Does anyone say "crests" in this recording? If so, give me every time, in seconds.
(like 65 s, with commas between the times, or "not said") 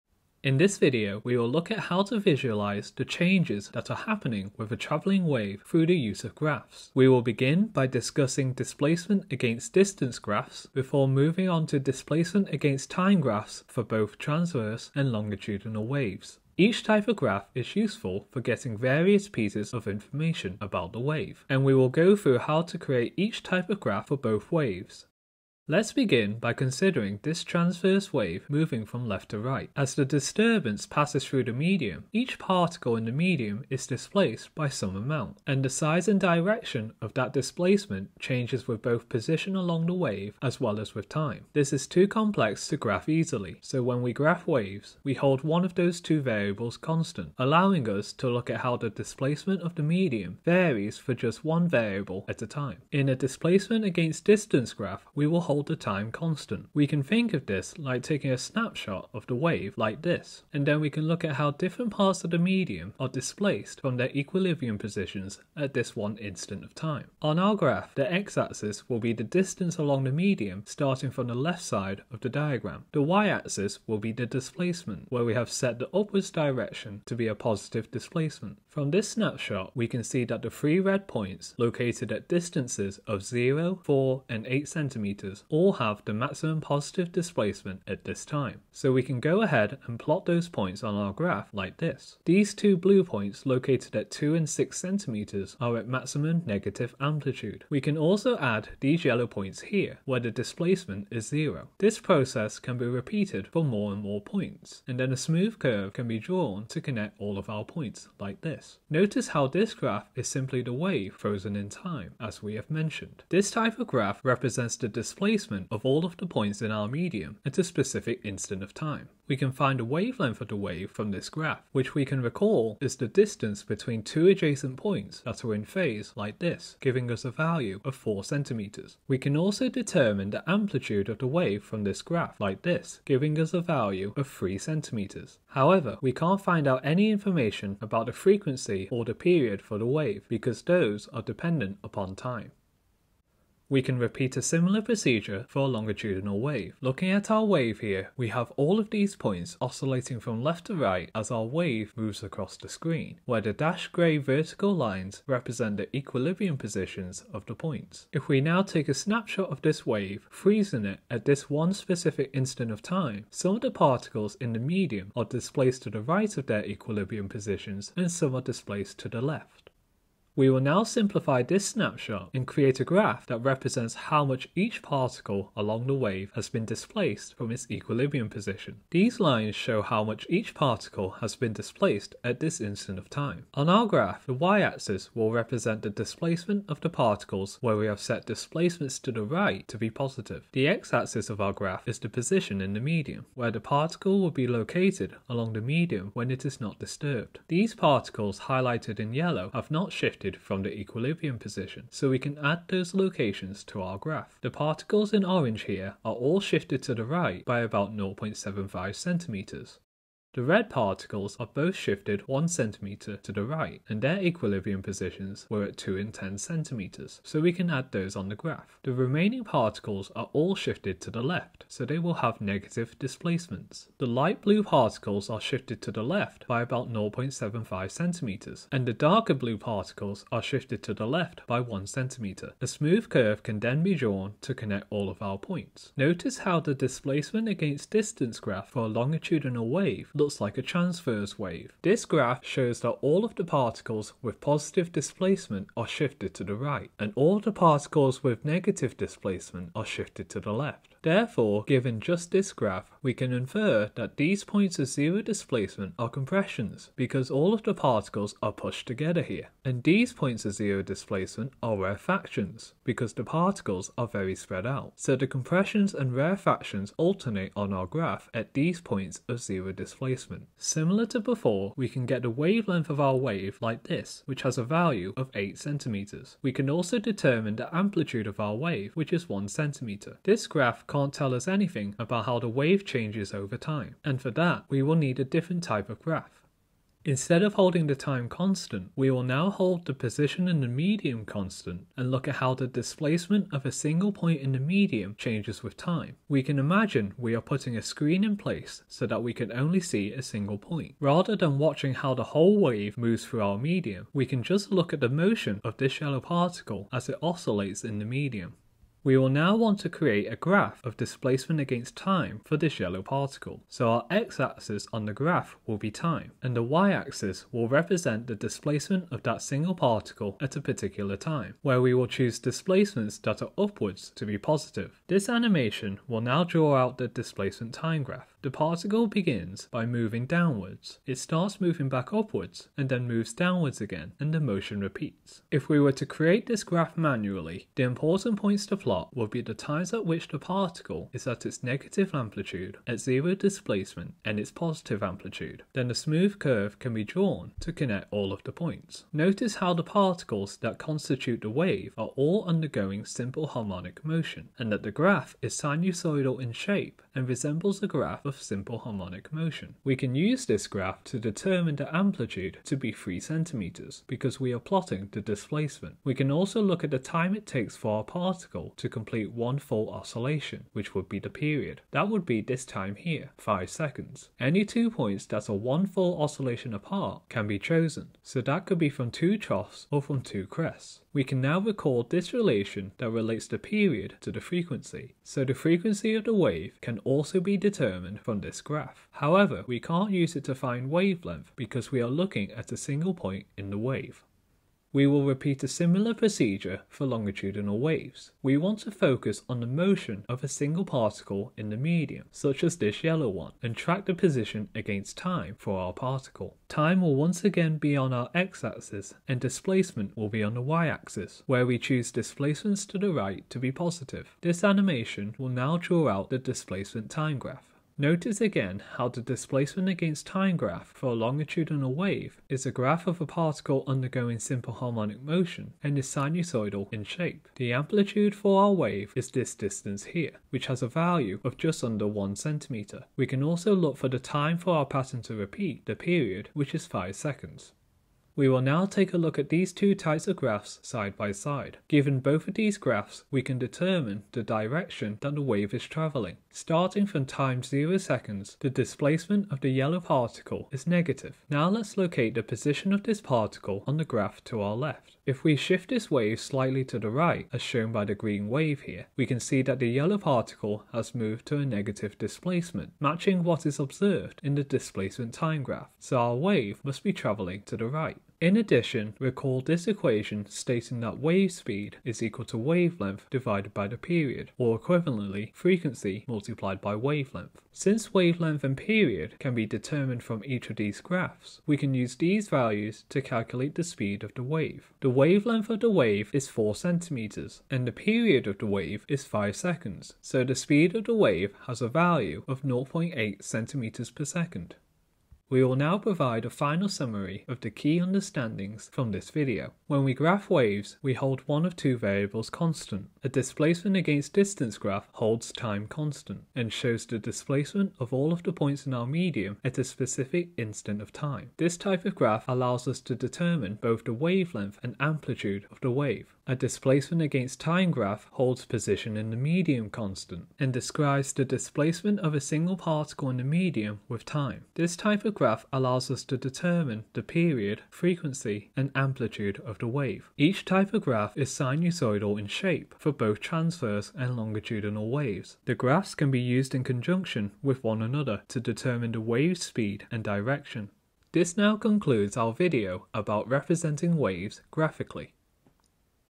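380 s.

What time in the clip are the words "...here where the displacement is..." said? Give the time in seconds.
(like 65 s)
99 s.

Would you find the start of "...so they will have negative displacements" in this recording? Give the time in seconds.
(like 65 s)
221 s.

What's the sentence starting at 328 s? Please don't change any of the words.
The particle begins by moving downwards.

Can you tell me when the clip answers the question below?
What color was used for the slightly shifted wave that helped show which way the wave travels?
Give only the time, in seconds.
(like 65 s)
458 s.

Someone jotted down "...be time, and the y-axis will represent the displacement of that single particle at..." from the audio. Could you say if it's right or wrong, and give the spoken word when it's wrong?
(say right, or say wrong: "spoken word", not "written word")
right.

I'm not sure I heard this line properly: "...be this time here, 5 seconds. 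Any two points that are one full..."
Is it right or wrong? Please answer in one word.
right.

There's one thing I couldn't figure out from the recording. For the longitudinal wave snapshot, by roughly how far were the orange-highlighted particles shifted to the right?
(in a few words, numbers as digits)
0.75 cm.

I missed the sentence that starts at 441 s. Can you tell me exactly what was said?
Given both of these graphs, we can determine the direction that the wave is travelling.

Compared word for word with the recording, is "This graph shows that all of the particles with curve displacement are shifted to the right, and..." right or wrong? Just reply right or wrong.
wrong.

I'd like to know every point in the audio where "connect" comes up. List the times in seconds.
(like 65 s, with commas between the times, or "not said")
106 s, 234 s, 347 s.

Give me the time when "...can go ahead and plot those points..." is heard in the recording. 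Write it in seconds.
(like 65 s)
89 s.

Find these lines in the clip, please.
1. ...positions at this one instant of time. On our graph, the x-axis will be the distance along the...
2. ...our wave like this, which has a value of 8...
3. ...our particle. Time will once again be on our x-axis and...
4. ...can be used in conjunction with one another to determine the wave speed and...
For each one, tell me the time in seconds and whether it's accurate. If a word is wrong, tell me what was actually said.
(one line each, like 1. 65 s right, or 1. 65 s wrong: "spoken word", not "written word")
1. 64 s right
2. 272 s right
3. 405 s right
4. 536 s right.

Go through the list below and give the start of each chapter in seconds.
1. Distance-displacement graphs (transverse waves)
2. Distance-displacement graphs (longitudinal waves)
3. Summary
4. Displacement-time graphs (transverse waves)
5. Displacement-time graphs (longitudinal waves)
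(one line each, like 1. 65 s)
1. 25 s
2. 142 s
3. 495 s
4. 286 s
5. 394 s.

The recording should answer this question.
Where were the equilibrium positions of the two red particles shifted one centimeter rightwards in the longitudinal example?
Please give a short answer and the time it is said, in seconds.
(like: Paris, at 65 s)
2 and 10 cm, at 215 s.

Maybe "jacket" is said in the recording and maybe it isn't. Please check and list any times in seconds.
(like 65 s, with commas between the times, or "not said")
not said.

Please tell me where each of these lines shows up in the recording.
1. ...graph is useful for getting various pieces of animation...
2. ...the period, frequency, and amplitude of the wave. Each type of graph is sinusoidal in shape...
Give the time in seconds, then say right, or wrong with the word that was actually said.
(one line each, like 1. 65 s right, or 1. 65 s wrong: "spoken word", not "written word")
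1. 17 s wrong: "information", not "animation"
2. 527 s right.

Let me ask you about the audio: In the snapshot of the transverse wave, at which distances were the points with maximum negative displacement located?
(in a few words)
2 and 6 cm.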